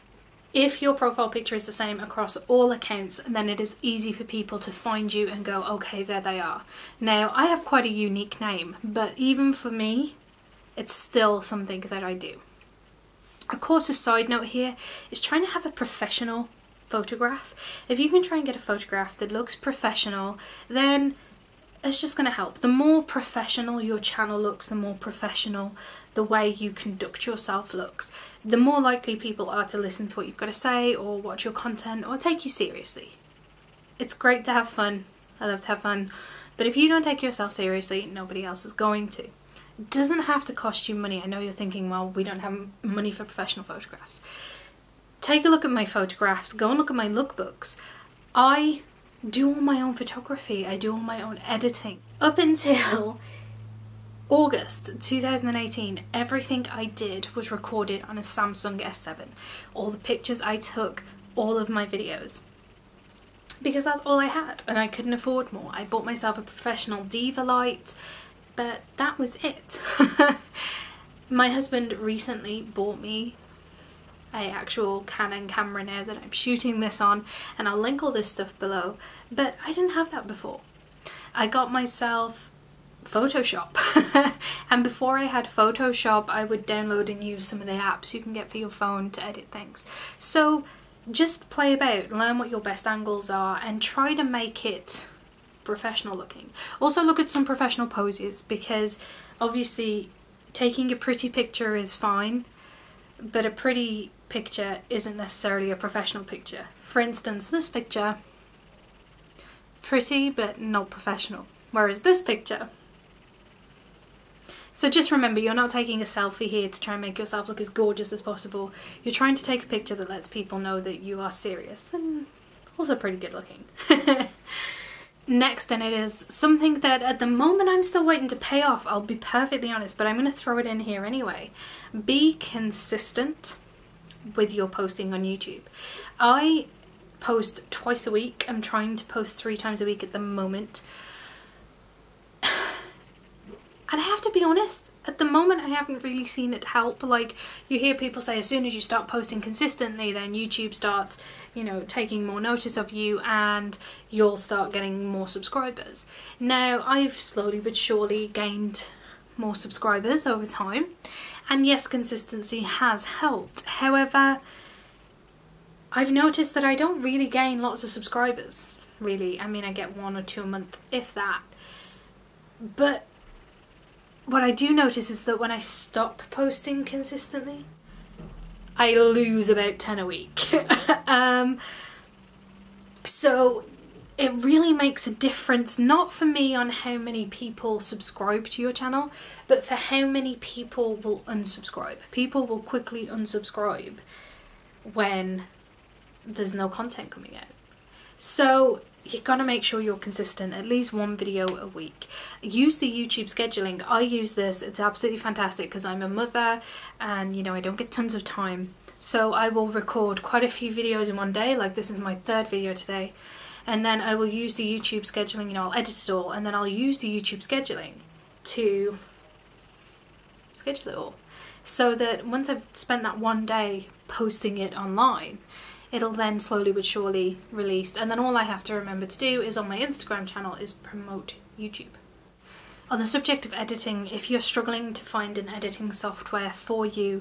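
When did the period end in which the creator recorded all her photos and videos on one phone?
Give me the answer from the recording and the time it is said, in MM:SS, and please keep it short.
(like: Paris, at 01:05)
August 2018, at 00:54.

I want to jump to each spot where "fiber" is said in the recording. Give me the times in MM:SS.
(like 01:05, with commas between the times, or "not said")
not said.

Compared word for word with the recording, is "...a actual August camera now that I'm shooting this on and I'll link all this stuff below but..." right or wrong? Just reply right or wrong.
wrong.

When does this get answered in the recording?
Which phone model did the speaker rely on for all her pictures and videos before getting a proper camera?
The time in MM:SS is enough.
00:58.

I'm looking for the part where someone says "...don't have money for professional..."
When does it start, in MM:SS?
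00:42.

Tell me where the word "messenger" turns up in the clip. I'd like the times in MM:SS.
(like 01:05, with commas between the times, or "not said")
not said.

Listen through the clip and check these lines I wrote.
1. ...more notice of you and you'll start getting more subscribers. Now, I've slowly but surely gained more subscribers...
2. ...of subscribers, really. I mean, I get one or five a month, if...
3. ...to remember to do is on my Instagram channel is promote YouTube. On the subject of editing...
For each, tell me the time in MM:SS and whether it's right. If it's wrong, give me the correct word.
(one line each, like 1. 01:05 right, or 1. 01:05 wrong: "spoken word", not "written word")
1. 02:32 right
2. 02:47 wrong: "two", not "five"
3. 03:48 right.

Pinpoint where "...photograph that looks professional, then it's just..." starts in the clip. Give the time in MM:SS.
00:18.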